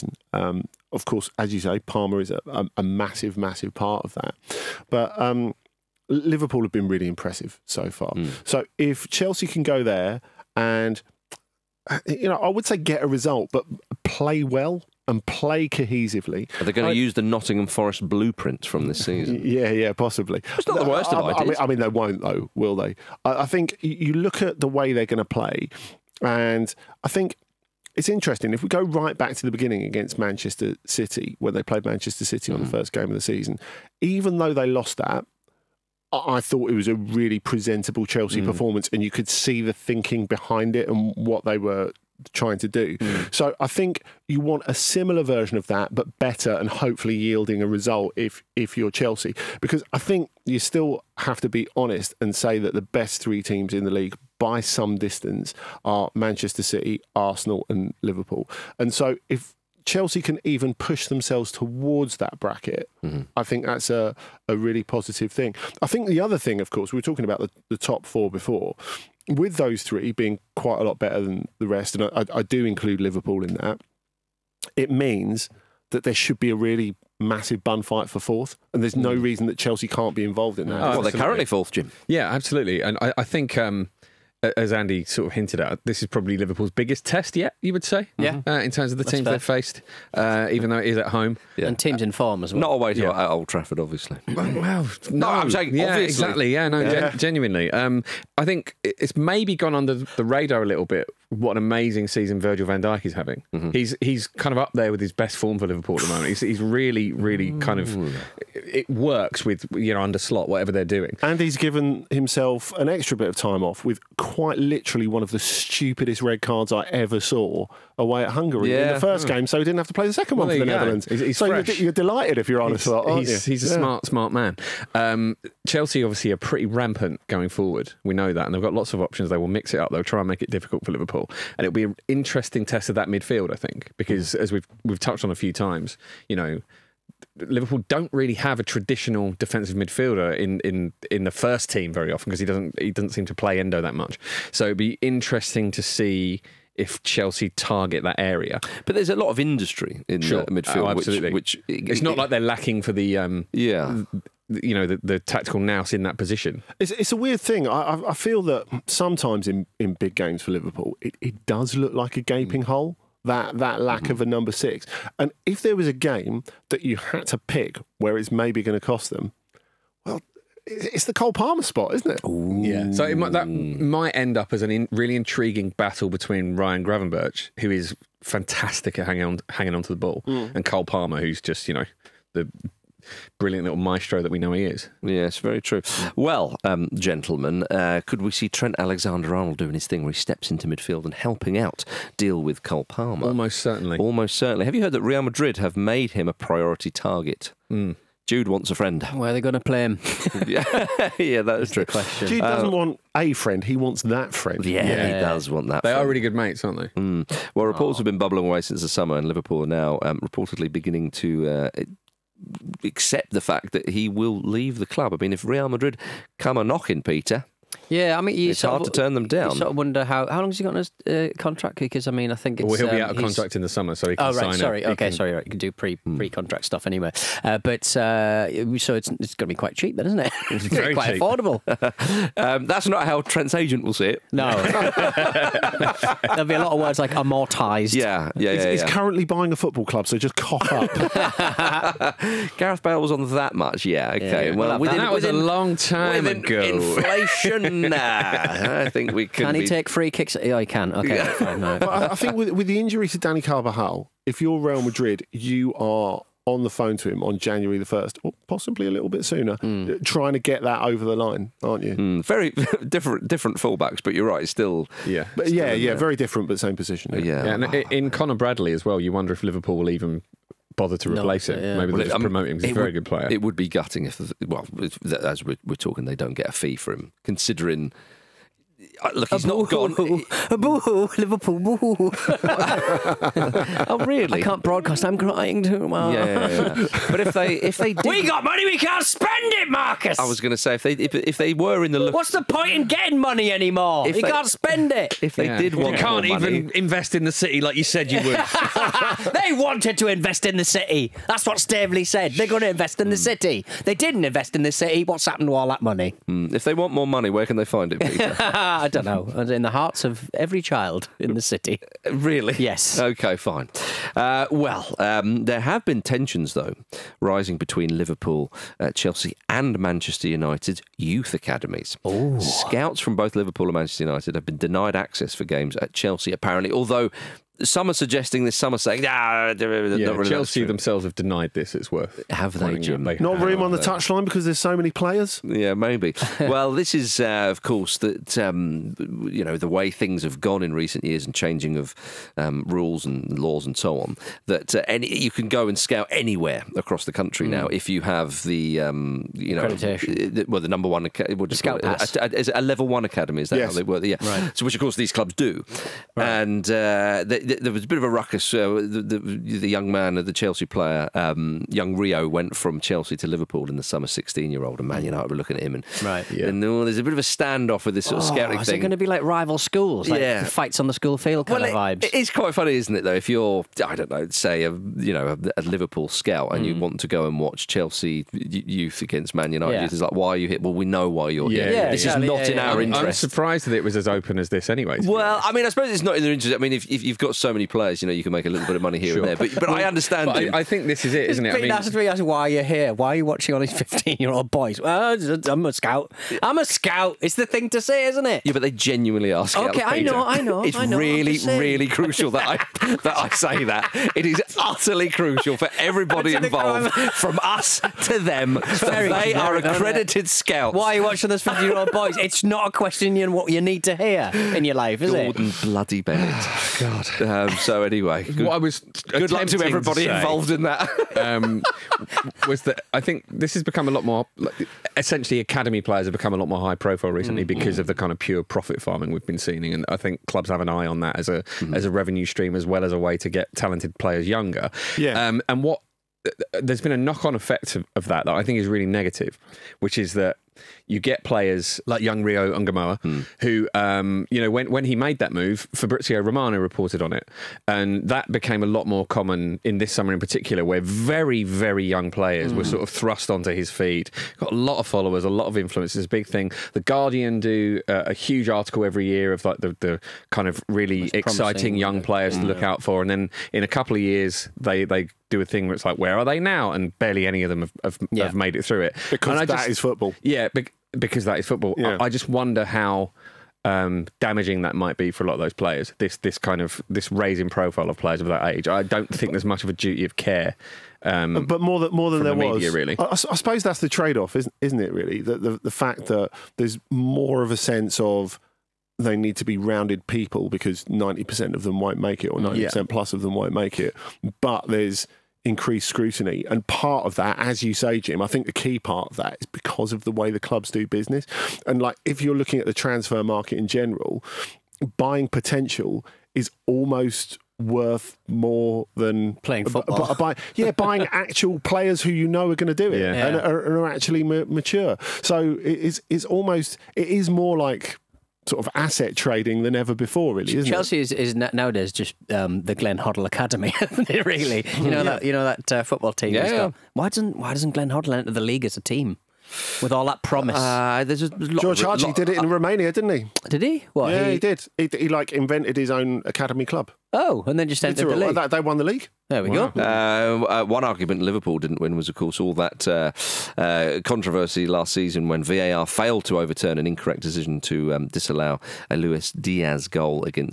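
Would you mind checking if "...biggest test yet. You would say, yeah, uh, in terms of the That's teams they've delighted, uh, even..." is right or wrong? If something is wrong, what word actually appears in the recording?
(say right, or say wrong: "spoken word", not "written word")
wrong: "faced", not "delighted".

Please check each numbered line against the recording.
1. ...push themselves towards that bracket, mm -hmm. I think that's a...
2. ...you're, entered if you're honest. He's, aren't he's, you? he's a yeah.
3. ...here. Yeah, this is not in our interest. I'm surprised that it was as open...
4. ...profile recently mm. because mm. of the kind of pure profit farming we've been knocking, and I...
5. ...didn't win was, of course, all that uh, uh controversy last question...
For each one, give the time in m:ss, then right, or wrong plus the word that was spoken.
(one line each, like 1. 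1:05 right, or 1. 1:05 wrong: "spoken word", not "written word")
1. 1:00 right
2. 2:01 wrong: "delighted", not "entered"
3. 6:21 right
4. 7:06 wrong: "seeing", not "knocking"
5. 9:01 wrong: "season", not "question".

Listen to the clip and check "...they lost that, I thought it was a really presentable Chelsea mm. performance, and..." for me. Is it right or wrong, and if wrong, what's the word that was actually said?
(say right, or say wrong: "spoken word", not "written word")
right.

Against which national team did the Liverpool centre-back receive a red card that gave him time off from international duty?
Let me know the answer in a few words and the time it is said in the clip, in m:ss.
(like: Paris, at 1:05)
Hungary, at 1:58.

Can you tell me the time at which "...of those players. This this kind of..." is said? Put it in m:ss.
7:55.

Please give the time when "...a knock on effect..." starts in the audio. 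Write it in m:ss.
7:16.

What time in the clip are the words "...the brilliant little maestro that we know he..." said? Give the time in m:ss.
3:02.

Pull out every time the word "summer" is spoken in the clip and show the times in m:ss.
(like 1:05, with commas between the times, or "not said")
3:28, 3:43, 6:03, 7:29.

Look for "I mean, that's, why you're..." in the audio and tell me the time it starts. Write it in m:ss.
6:31.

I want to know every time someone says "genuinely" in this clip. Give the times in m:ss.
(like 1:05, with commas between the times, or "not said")
1:37, 6:38.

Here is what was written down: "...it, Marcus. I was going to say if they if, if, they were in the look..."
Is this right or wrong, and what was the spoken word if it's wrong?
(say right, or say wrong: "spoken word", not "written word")
right.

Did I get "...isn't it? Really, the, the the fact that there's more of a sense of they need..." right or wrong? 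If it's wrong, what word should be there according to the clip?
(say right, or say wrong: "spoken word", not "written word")
right.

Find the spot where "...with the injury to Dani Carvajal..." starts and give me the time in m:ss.
4:12.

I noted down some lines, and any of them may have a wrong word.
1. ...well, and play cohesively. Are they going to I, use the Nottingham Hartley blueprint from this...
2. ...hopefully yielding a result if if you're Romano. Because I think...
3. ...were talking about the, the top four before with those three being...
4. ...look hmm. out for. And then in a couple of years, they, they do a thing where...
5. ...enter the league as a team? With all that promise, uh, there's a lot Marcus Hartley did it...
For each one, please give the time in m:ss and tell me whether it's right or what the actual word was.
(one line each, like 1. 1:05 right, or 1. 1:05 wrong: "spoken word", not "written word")
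1. 0:14 wrong: "Forest", not "Hartley"
2. 0:46 wrong: "Chelsea", not "Romano"
3. 1:07 right
4. 7:42 right
5. 8:48 wrong: "George", not "Marcus".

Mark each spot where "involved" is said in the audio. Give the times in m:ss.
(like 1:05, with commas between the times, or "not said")
1:20, 6:46, 7:00.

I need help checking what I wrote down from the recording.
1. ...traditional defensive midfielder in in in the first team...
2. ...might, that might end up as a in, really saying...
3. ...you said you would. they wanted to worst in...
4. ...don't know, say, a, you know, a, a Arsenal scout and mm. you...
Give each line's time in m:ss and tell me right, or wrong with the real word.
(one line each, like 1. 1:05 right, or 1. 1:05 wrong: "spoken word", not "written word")
1. 2:18 right
2. 2:53 wrong: "intriguing", not "saying"
3. 4:57 wrong: "invest", not "worst"
4. 6:13 wrong: "Liverpool", not "Arsenal".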